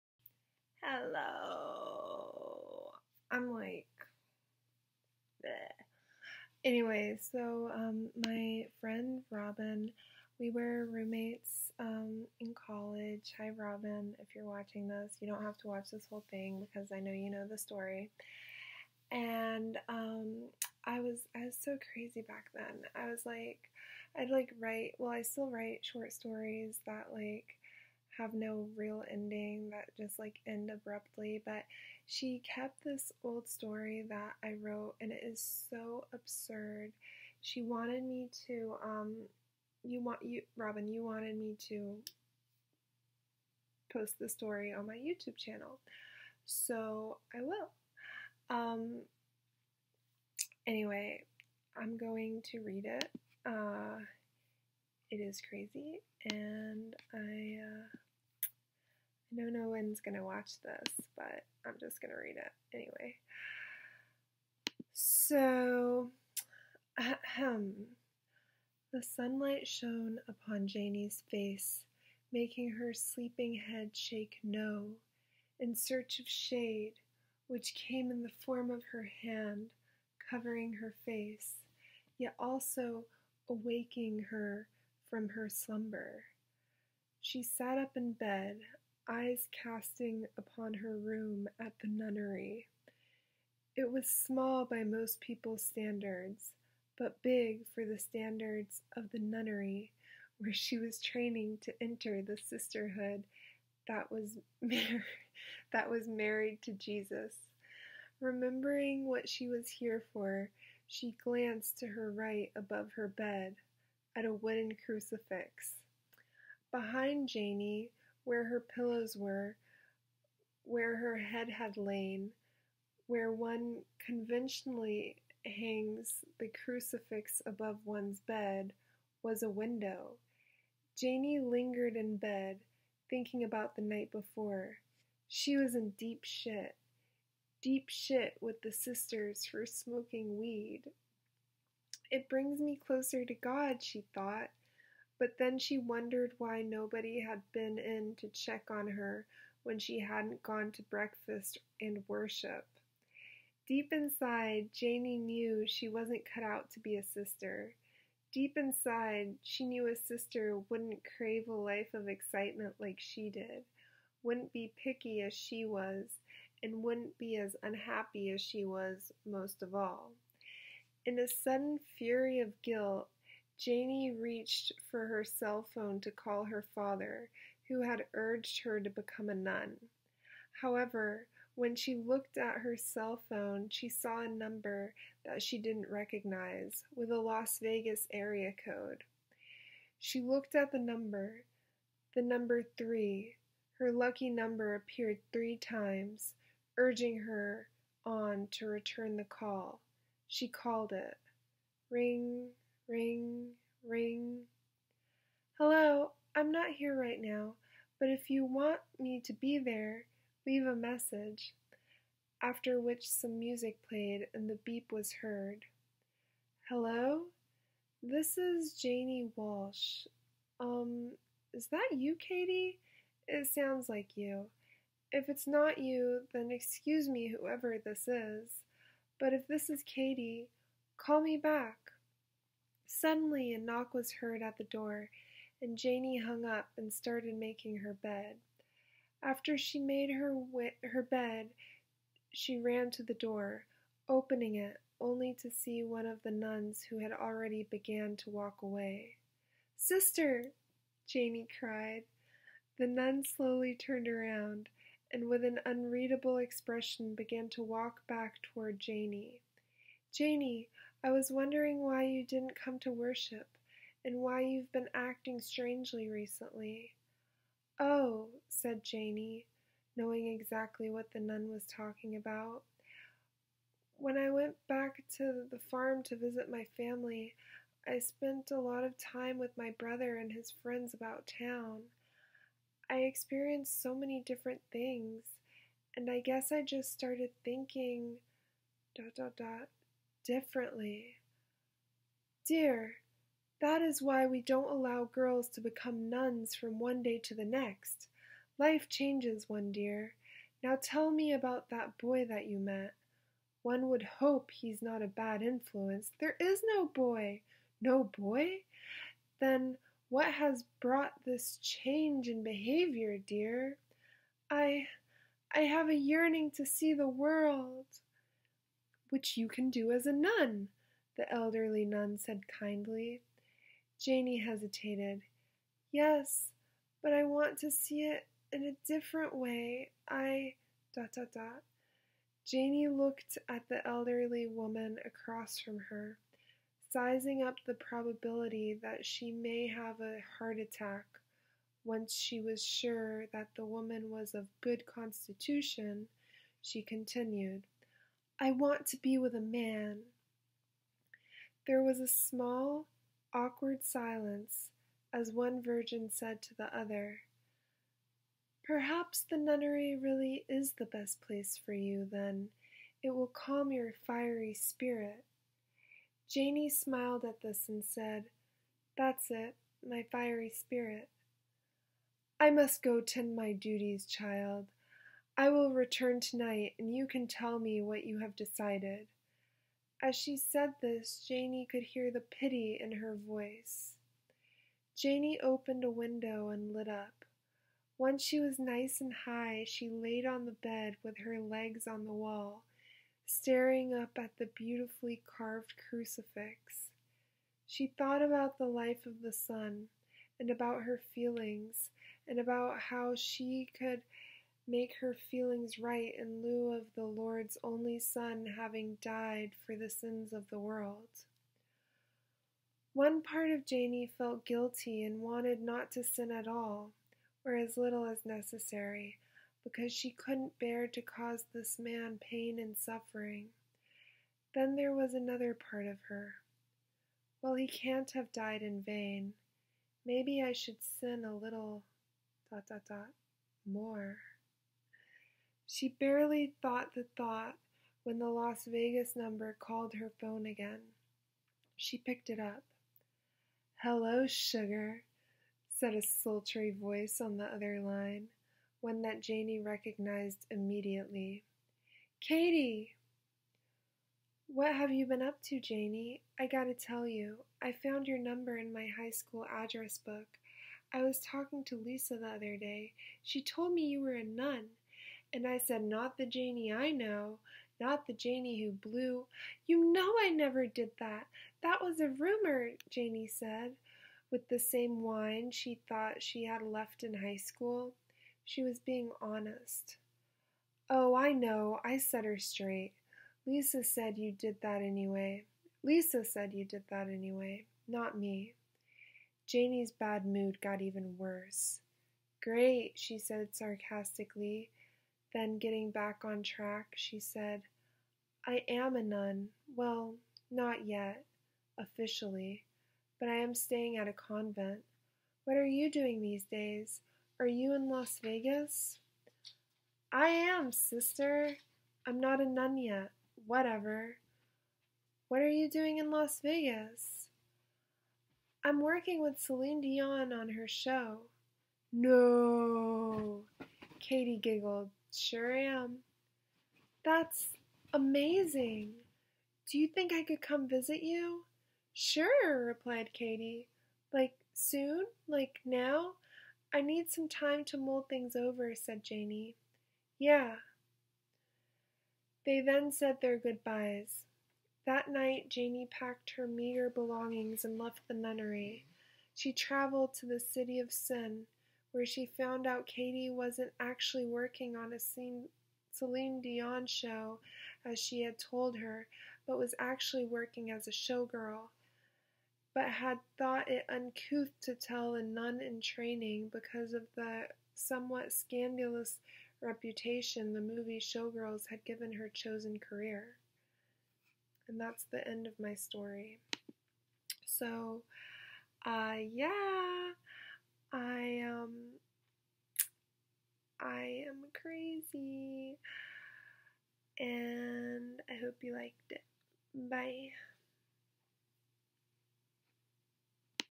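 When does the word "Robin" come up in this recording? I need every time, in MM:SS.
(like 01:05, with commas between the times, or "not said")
00:09, 00:13, 00:40.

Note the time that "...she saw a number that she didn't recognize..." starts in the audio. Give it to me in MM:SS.
03:03.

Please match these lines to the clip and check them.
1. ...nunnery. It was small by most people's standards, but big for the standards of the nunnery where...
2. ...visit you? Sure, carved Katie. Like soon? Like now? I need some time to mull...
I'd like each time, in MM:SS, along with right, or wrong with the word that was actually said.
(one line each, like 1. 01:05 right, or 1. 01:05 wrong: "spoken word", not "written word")
1. 01:31 right
2. 08:50 wrong: "replied", not "carved".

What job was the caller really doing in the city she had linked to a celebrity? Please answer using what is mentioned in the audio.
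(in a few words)
showgirl.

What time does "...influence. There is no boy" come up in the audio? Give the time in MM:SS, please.
05:05.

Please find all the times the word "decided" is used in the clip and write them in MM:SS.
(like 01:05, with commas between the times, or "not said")
06:18.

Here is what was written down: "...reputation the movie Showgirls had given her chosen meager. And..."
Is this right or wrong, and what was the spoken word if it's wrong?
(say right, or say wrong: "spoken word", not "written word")
wrong: "career", not "meager".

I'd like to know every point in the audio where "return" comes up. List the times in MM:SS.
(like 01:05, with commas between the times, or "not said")
03:18, 06:15.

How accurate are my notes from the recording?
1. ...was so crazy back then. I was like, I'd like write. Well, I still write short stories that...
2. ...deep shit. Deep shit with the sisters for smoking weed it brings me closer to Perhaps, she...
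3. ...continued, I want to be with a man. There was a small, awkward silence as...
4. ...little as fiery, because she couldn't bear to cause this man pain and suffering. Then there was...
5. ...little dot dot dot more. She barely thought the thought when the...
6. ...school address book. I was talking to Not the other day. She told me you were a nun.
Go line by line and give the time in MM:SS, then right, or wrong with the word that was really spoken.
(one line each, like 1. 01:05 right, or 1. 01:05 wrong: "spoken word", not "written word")
1. 00:21 right
2. 02:15 wrong: "God", not "Perhaps"
3. 05:46 right
4. 06:57 wrong: "necessary", not "fiery"
5. 07:11 right
6. 07:39 wrong: "Lisa", not "Not".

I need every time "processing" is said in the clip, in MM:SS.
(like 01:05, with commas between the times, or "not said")
not said.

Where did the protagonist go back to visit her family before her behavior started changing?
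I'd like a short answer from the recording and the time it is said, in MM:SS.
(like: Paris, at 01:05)
the farm, at 04:35.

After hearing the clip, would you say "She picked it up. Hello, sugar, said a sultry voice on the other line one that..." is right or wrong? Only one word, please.
right.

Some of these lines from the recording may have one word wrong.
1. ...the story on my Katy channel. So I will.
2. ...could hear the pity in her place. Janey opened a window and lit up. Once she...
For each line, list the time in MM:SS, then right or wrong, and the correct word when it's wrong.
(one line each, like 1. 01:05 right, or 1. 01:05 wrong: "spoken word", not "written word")
1. 00:44 wrong: "YouTube", not "Katy"
2. 06:21 wrong: "voice", not "place".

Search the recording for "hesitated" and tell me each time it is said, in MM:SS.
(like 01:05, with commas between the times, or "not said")
05:24.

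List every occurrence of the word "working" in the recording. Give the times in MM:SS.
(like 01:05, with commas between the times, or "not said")
08:38, 09:14, 09:20.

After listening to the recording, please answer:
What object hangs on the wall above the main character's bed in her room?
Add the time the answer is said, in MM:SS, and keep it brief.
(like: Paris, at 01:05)
wooden crucifix, at 01:54.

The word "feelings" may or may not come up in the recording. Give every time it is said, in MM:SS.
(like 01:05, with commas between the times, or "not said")
06:41, 06:45.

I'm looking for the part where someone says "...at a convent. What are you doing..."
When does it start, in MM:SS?
08:23.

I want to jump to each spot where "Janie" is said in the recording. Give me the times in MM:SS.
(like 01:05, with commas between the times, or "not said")
01:10, 02:34, 02:53, 03:38, 08:09.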